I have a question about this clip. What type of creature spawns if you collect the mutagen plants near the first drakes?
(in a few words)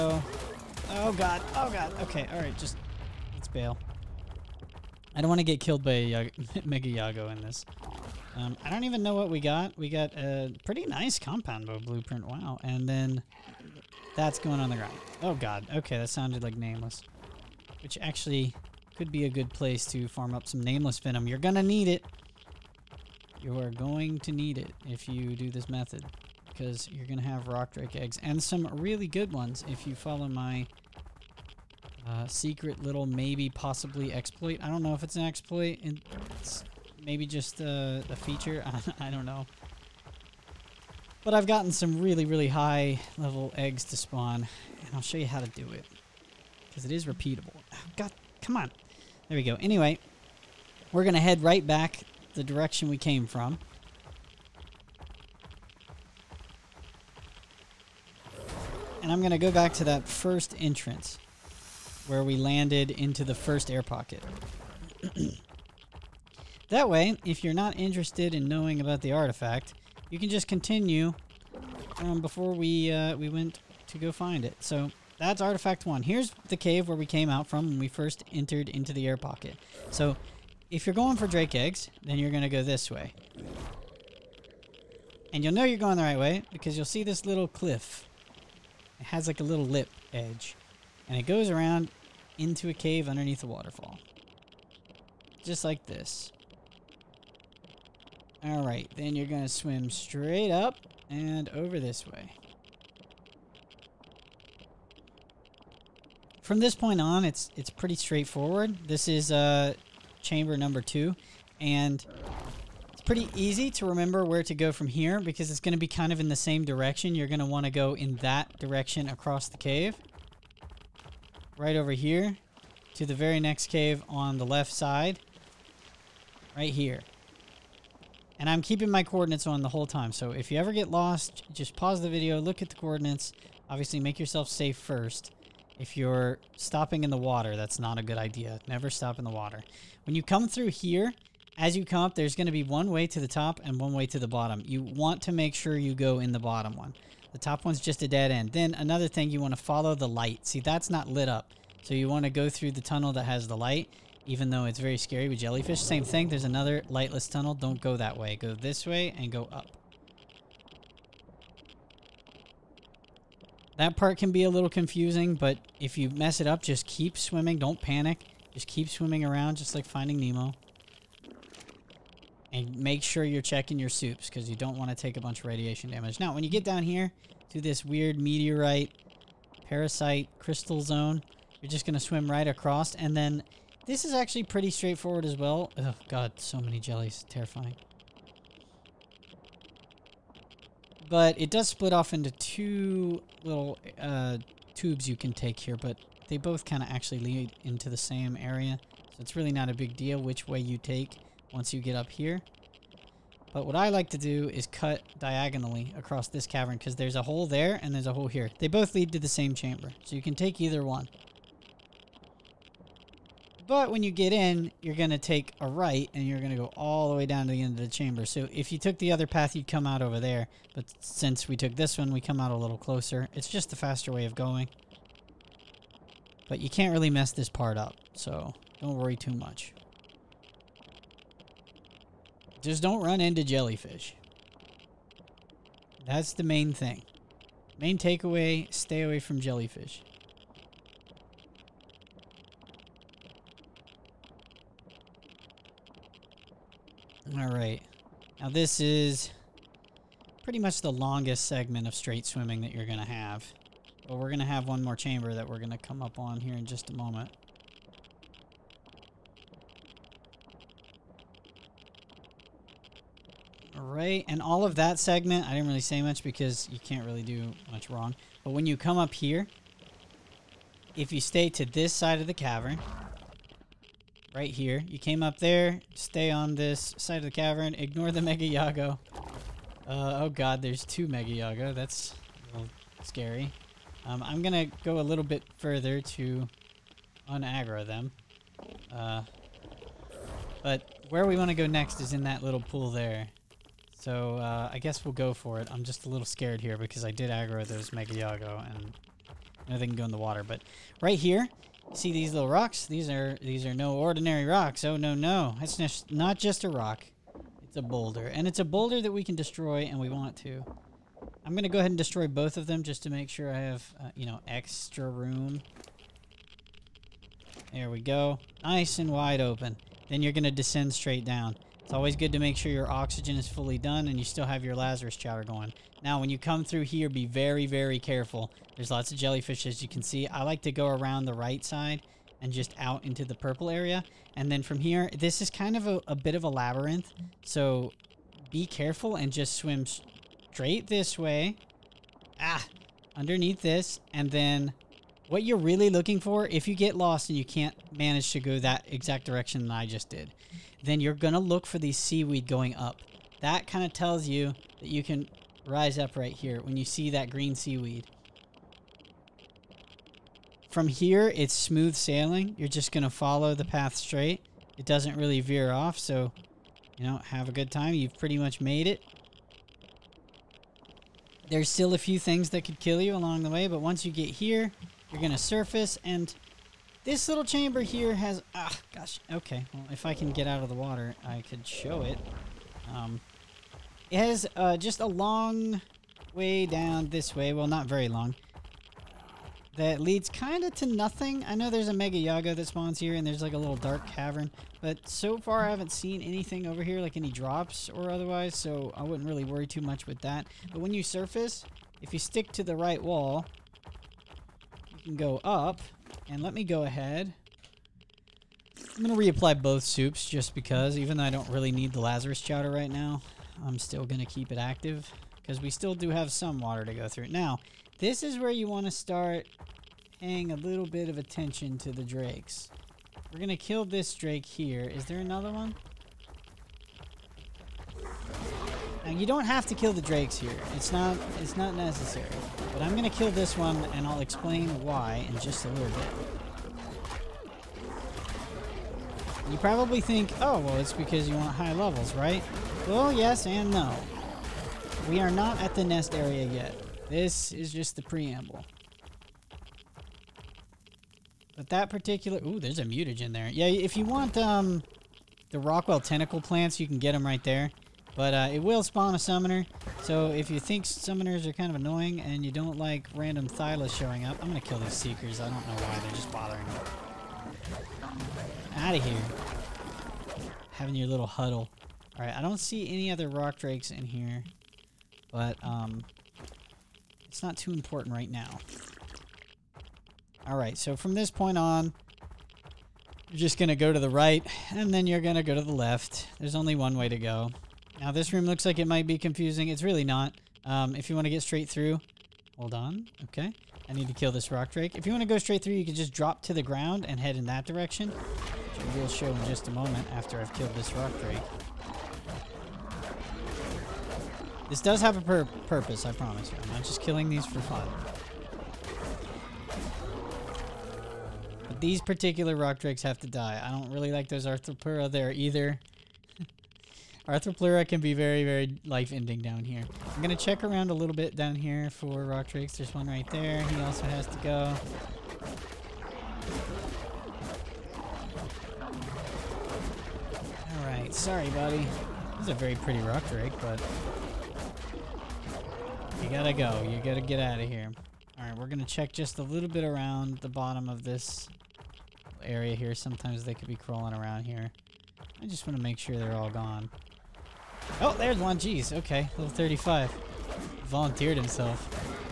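A summoner.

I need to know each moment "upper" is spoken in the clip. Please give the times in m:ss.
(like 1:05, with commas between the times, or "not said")
not said.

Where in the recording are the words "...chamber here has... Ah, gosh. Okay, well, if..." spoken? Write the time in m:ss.
6:17.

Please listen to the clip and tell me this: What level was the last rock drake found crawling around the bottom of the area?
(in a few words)
35.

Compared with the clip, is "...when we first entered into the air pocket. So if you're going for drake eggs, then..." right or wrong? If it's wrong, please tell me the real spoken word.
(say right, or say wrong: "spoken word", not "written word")
right.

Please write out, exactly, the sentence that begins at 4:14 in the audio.
But we're going to have one more chamber that we're going to come up on here in just a moment.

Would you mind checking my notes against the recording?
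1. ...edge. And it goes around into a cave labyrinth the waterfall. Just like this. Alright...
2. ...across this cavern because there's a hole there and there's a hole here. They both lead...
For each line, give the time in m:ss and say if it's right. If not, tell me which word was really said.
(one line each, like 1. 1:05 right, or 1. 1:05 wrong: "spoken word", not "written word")
1. 1:30 wrong: "underneath", not "labyrinth"
2. 3:25 right.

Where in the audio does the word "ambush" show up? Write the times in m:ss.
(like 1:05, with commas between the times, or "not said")
not said.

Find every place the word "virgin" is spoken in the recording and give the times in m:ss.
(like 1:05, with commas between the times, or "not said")
not said.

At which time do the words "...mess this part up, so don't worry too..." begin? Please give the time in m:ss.
3:47.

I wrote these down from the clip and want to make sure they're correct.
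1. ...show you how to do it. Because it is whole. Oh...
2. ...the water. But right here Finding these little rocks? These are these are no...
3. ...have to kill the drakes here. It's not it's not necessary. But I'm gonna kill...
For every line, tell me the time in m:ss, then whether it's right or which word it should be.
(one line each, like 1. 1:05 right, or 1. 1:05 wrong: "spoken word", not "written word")
1. 0:45 wrong: "repeatable", not "whole"
2. 5:00 wrong: "See", not "Finding"
3. 7:09 right.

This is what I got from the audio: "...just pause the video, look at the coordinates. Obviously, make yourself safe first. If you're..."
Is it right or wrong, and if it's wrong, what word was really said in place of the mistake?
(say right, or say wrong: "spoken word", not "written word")
right.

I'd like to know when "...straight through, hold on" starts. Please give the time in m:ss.
8:11.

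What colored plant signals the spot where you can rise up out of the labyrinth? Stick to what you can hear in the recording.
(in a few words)
Green seaweed.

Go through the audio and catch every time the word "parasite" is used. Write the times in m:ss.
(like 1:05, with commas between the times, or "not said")
2:59.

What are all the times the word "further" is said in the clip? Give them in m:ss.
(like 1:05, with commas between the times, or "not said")
4:45.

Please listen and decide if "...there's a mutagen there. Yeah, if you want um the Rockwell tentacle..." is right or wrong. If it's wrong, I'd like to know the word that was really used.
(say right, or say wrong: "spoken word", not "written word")
right.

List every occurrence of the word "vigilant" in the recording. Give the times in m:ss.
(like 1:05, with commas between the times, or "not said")
not said.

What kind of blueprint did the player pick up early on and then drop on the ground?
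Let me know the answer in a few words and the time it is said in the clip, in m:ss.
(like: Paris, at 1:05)
Compound bow, at 0:11.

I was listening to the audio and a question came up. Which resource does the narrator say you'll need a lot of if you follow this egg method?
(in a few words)
Nameless Venom.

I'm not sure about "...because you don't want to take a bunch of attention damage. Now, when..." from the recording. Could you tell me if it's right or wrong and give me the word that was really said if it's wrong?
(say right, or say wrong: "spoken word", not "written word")
wrong: "radiation", not "attention".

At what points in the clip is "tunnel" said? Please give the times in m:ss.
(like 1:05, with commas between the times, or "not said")
2:32, 2:37.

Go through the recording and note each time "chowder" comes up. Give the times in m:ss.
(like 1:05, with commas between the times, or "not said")
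5:25, 6:52.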